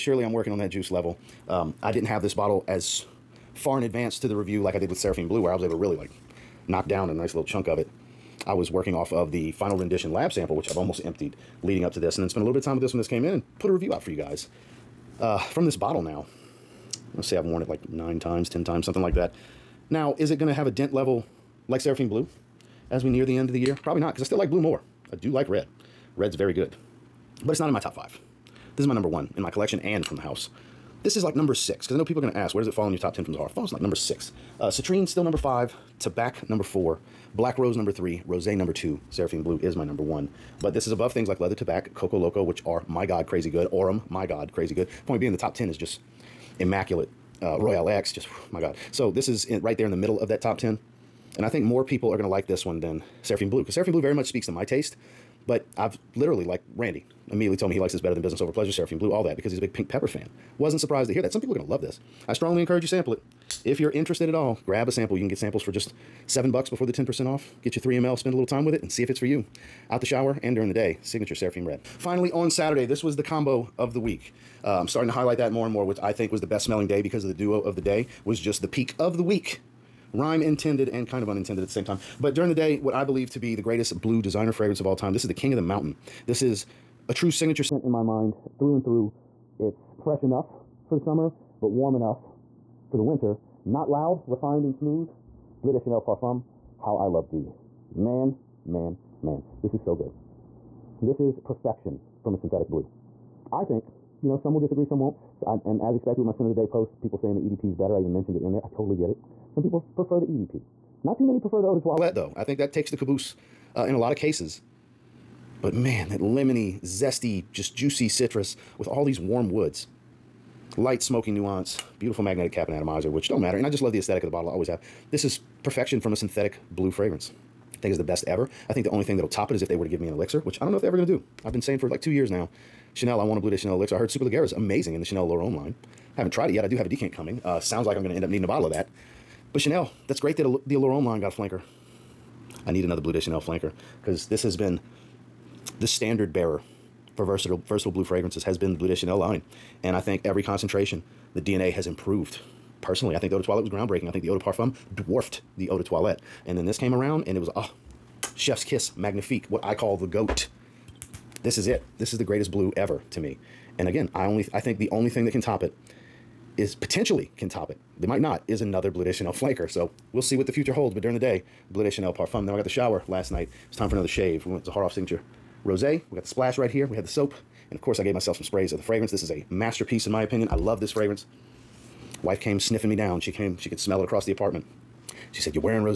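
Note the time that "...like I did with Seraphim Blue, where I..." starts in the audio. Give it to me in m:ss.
0:04.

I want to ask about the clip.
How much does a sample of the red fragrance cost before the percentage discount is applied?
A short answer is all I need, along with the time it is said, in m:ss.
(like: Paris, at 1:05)
$7, at 1:06.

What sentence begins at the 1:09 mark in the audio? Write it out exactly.
Out the shower and during the day, signature Seraphim Red.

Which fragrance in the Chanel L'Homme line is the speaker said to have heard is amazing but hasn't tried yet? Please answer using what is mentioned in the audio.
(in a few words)
Superleggera.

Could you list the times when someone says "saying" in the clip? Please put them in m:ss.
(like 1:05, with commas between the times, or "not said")
1:47, 2:11.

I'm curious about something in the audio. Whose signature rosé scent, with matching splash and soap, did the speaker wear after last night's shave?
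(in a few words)
Zaharoff.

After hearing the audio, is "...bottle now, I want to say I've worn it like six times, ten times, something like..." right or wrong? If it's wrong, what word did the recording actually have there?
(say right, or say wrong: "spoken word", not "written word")
wrong: "nine", not "six".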